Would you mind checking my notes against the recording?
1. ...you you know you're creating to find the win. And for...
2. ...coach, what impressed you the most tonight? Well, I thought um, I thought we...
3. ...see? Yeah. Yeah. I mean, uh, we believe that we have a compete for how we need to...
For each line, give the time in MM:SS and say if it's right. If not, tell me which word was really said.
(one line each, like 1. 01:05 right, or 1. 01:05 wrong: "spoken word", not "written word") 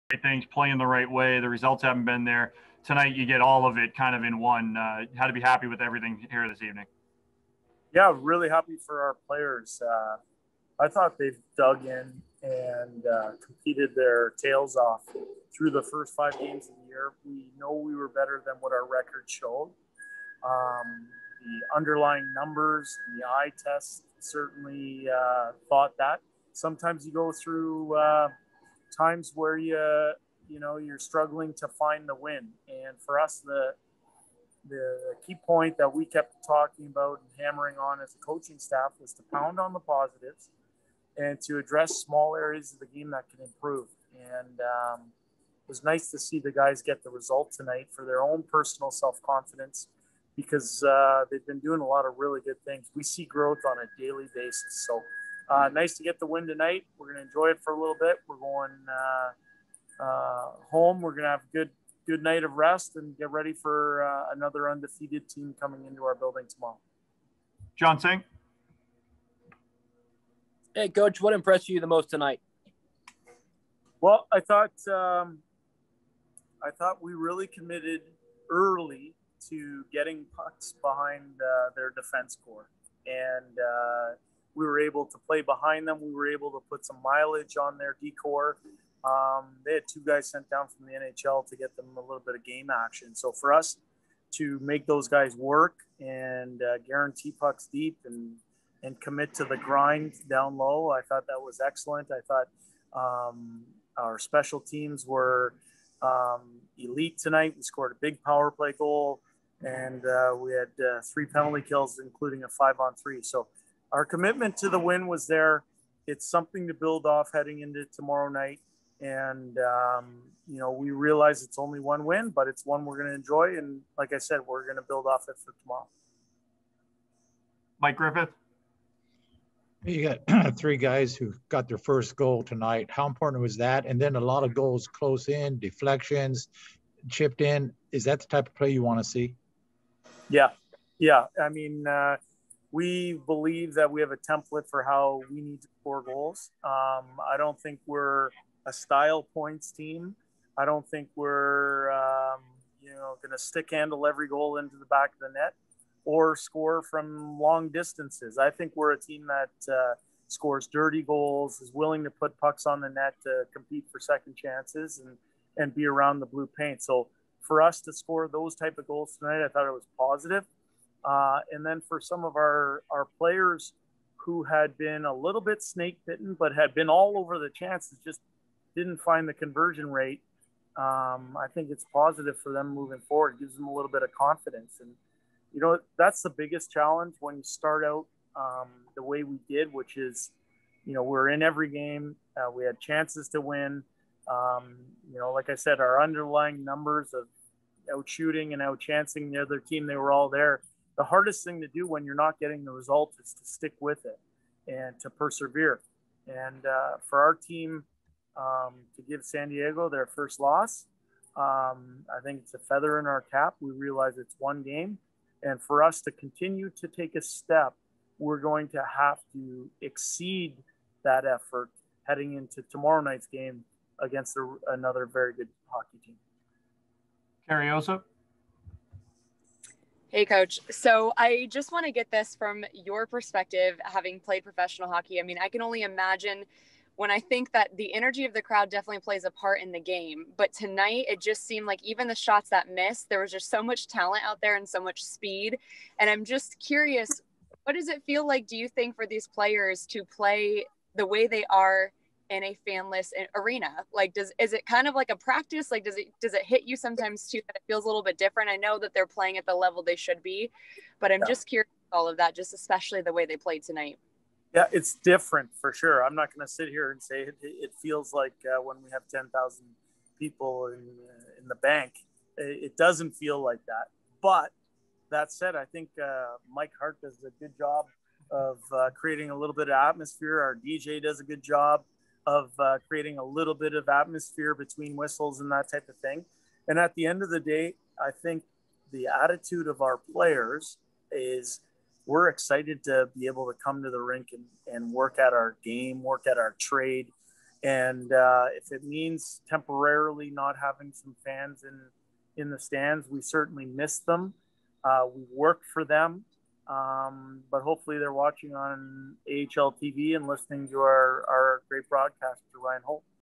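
1. 00:29 wrong: "struggling", not "creating"
2. 01:10 right
3. 02:19 wrong: "template", not "compete".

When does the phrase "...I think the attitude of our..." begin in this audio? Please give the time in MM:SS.
04:47.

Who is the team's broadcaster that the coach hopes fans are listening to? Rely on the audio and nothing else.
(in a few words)
Ryan Holt.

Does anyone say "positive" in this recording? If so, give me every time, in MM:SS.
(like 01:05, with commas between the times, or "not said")
00:39, 02:49, 03:01.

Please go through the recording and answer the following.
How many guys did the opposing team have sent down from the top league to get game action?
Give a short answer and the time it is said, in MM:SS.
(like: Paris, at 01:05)
2, at 01:29.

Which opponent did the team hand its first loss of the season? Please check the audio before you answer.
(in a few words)
San Diego.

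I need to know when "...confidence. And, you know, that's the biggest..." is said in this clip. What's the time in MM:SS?
03:04.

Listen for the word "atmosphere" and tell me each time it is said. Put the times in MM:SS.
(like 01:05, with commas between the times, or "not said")
04:39, 04:43.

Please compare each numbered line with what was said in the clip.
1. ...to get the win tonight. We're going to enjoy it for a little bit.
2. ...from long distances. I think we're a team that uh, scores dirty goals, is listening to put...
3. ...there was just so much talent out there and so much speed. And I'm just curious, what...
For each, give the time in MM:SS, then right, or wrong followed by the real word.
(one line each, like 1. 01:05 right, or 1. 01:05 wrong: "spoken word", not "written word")
1. 00:55 right
2. 02:36 wrong: "willing", not "listening"
3. 04:03 right.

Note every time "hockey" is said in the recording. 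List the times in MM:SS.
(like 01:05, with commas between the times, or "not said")
03:45, 03:54.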